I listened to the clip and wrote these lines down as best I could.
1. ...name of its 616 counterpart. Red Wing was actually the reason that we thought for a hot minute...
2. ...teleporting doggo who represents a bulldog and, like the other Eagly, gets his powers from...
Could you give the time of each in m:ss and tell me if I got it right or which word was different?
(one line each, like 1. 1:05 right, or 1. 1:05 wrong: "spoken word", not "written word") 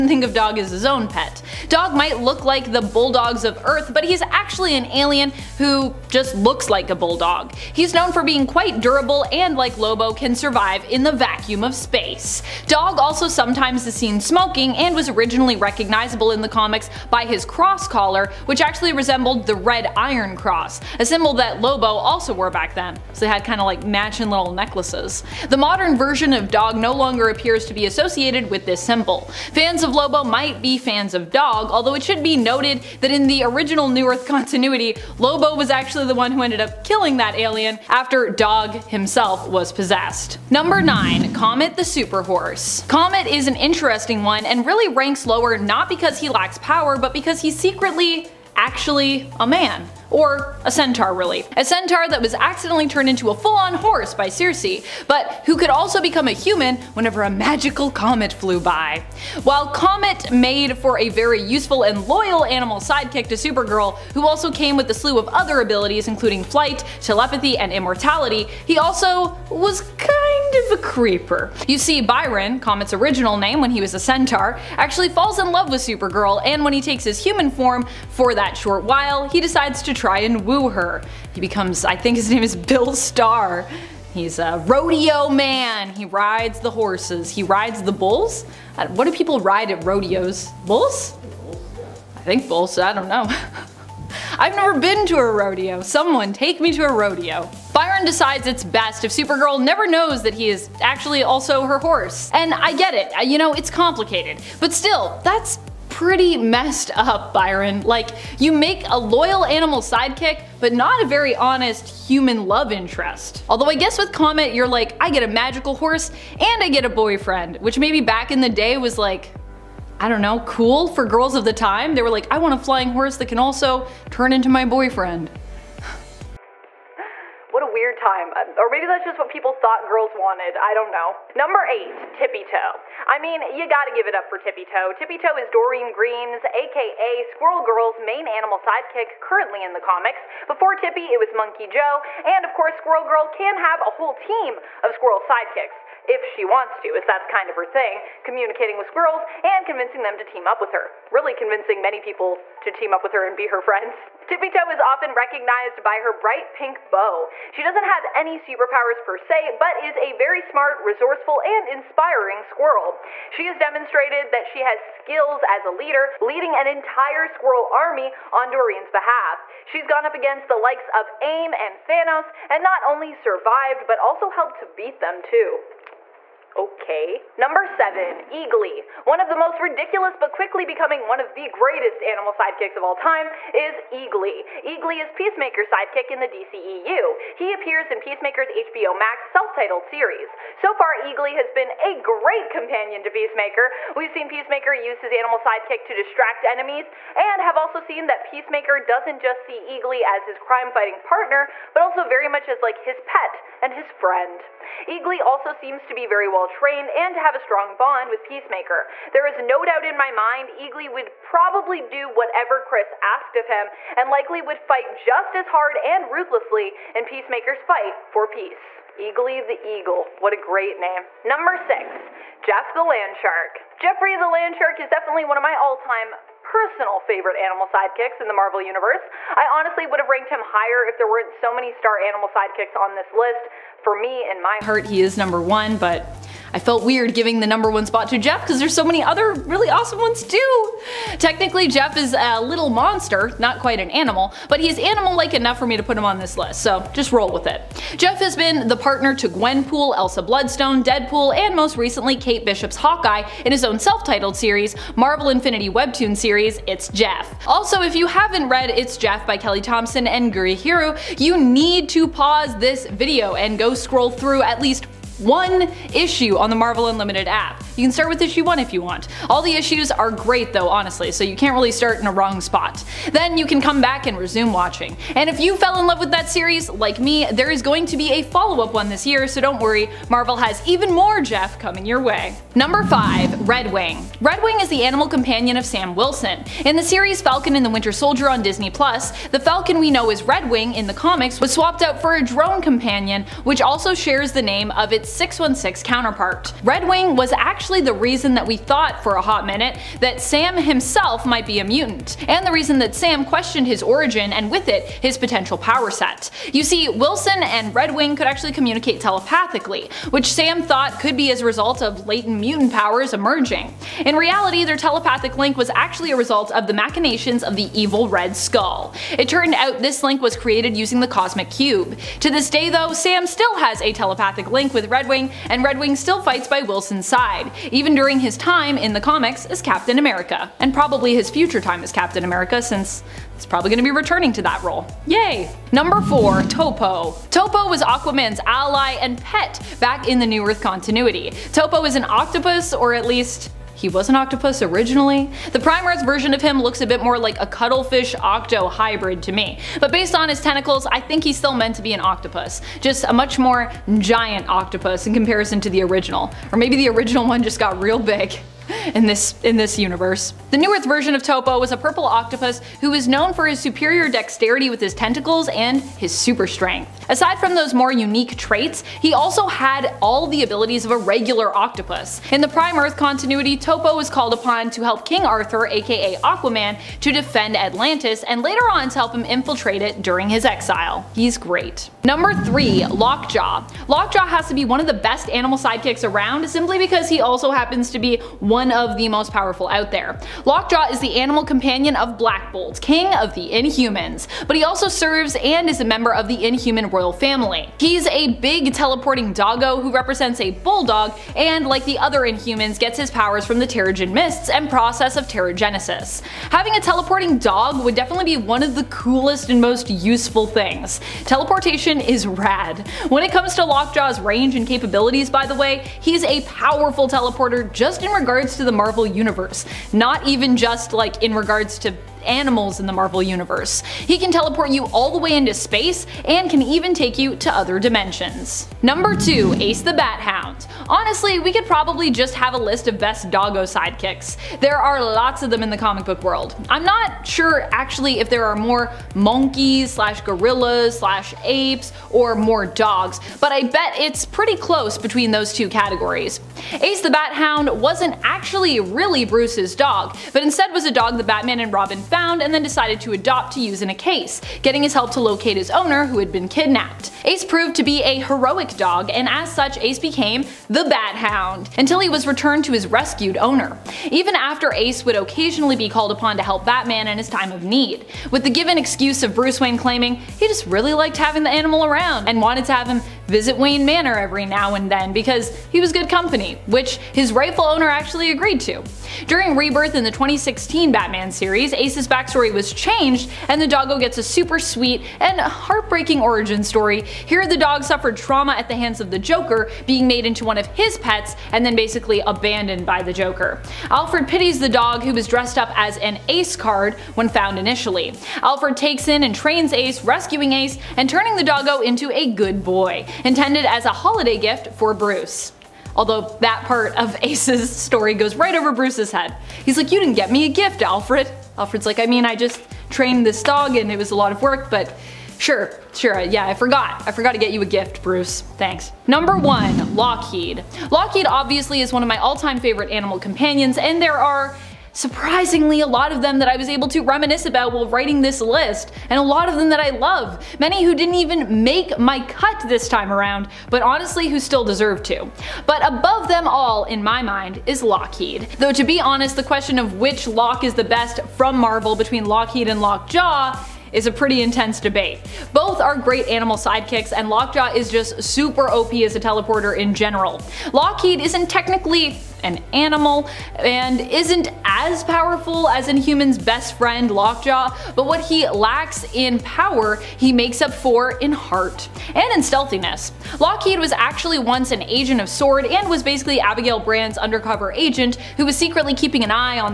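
1. 4:54 right
2. 6:38 wrong: "Inhumans", not "Eagly".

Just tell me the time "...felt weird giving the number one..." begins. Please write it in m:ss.
3:56.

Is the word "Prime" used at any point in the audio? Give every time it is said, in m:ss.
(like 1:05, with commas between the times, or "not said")
5:45, 6:12.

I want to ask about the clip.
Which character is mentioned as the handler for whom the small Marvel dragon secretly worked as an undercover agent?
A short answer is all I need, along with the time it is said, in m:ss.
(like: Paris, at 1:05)
Abigail Brand, at 9:26.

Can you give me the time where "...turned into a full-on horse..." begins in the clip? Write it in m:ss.
0:52.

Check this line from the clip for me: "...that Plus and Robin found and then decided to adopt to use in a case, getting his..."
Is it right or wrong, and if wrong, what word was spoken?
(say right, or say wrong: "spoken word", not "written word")
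wrong: "Batman", not "Plus".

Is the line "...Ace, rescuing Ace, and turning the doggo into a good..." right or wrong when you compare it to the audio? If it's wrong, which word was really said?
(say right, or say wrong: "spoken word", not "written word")
right.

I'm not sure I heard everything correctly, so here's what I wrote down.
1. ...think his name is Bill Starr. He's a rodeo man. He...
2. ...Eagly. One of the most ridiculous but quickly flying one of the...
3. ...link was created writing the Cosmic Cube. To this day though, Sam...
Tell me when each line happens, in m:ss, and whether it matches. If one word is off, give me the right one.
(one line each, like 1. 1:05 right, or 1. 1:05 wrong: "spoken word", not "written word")
1. 1:21 right
2. 2:58 wrong: "becoming", not "flying"
3. 5:20 wrong: "using", not "writing".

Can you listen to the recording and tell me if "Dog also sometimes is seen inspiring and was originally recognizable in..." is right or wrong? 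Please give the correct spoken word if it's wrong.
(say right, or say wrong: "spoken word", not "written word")
wrong: "smoking", not "inspiring".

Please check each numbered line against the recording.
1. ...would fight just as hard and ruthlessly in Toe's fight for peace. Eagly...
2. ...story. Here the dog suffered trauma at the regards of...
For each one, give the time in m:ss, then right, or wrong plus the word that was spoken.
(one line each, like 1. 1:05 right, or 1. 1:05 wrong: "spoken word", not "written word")
1. 3:34 wrong: "Peacemaker", not "Toe"
2. 8:06 wrong: "hands", not "regards".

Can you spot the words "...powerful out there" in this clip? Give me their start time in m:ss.
6:29.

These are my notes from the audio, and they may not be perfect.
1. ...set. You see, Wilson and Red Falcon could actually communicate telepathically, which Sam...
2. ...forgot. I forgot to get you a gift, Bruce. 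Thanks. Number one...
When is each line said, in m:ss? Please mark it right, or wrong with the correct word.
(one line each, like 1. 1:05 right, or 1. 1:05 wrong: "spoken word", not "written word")
1. 5:05 wrong: "Wing", not "Falcon"
2. 8:36 right.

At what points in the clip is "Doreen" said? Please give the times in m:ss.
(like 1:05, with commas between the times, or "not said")
2:15, 2:48.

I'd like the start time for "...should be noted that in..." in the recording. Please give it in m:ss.
0:32.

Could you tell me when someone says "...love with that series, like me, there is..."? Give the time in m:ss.
4:35.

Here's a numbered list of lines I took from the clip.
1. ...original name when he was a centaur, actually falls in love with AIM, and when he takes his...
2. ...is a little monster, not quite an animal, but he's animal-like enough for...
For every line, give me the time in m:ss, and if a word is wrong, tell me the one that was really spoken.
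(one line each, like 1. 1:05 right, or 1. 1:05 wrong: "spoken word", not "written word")
1. 1:12 wrong: "Supergirl", not "AIM"
2. 4:01 right.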